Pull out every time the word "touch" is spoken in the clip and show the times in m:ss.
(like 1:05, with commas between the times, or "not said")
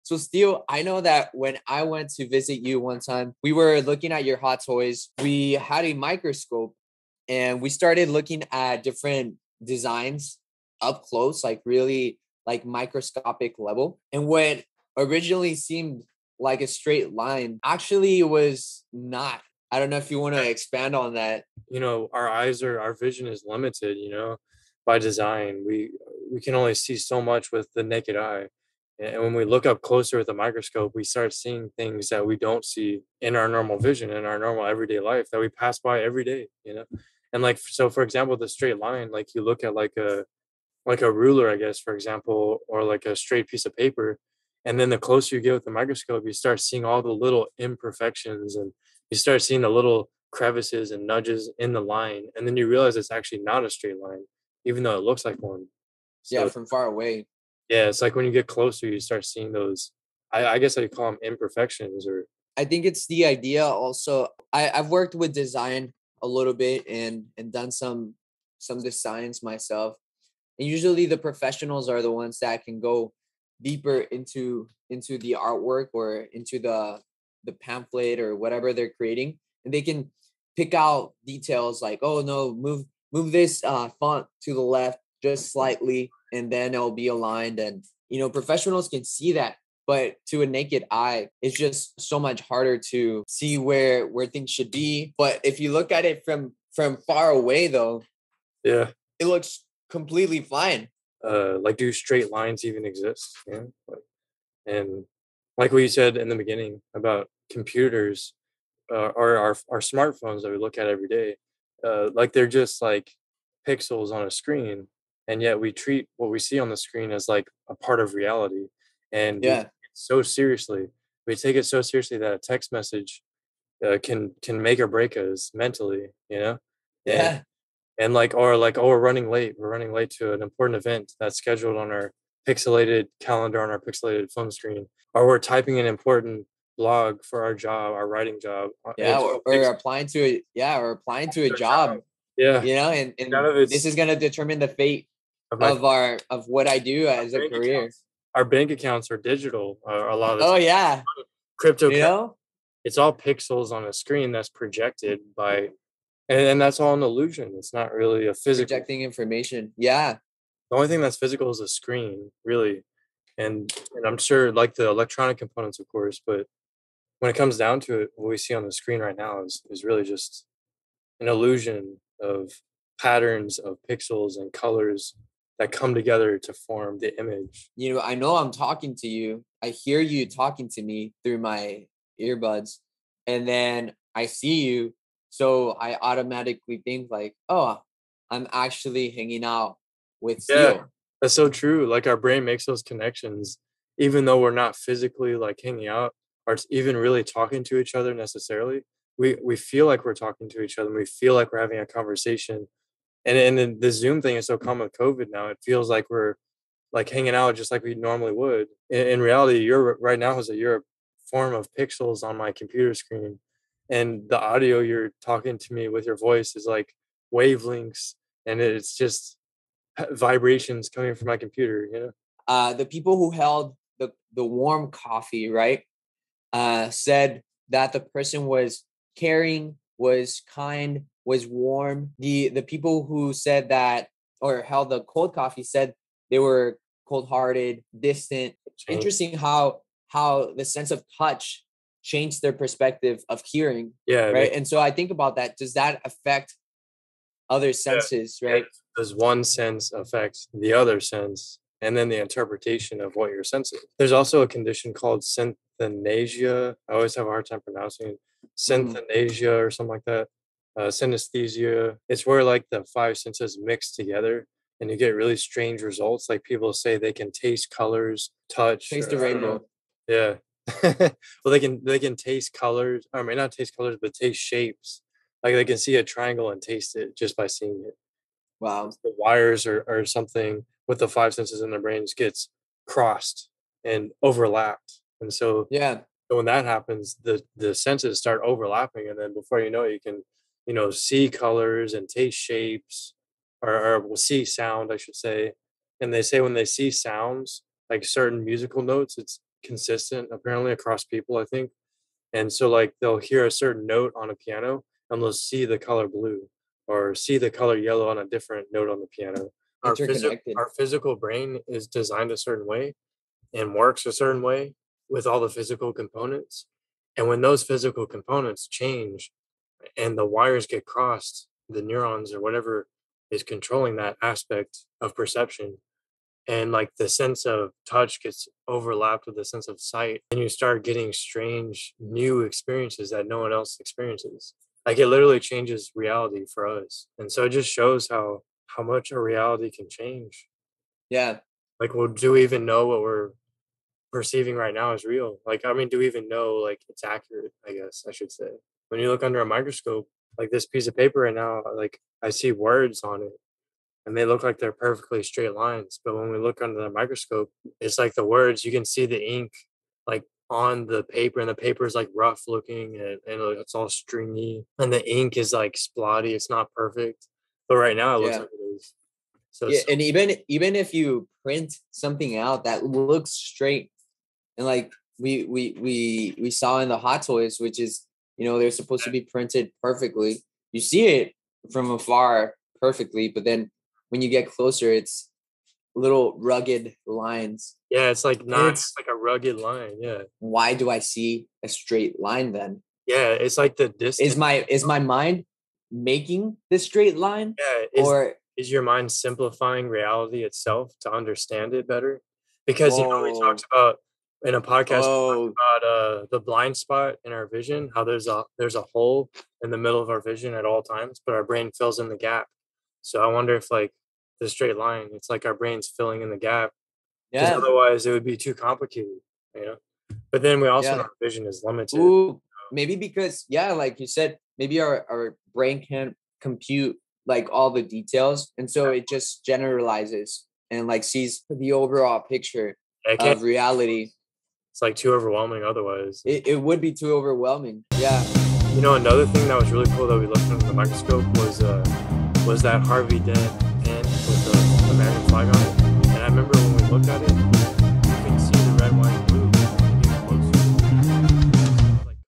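4:01, 4:28, 5:27.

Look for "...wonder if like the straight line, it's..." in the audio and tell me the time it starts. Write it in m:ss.
6:53.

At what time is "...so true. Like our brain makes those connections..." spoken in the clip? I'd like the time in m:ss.
3:11.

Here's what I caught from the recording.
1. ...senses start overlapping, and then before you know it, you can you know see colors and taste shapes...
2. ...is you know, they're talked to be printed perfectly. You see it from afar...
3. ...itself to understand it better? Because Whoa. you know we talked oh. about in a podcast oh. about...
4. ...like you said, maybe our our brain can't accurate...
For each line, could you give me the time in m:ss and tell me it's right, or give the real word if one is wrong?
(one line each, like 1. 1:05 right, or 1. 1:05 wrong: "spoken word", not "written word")
1. 4:47 right
2. 6:17 wrong: "supposed", not "talked"
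3. 6:40 right
4. 7:03 wrong: "compute", not "accurate".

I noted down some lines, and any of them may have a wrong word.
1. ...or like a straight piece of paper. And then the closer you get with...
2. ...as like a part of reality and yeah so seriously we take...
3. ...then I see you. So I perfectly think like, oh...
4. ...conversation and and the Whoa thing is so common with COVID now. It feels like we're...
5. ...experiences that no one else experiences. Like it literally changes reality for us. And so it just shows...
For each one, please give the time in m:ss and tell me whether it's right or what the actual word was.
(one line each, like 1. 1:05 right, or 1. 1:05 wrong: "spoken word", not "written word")
1. 0:42 right
2. 1:57 right
3. 3:03 wrong: "automatically", not "perfectly"
4. 3:21 wrong: "Zoom", not "Whoa"
5. 5:32 right.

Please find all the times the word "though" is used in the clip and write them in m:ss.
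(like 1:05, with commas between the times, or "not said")
0:54, 1:37, 3:14.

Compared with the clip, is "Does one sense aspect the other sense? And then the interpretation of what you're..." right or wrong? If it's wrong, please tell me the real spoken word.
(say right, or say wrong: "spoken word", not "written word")
wrong: "affect", not "aspect".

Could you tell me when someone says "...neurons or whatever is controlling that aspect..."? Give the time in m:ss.
5:21.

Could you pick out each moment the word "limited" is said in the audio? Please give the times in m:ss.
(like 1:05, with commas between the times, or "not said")
0:23, 7:01.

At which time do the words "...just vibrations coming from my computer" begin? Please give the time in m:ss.
3:38.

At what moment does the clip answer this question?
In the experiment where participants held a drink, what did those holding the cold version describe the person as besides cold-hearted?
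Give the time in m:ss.
3:57.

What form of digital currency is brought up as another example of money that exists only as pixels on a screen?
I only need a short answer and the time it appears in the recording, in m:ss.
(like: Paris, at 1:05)
crypto, at 2:31.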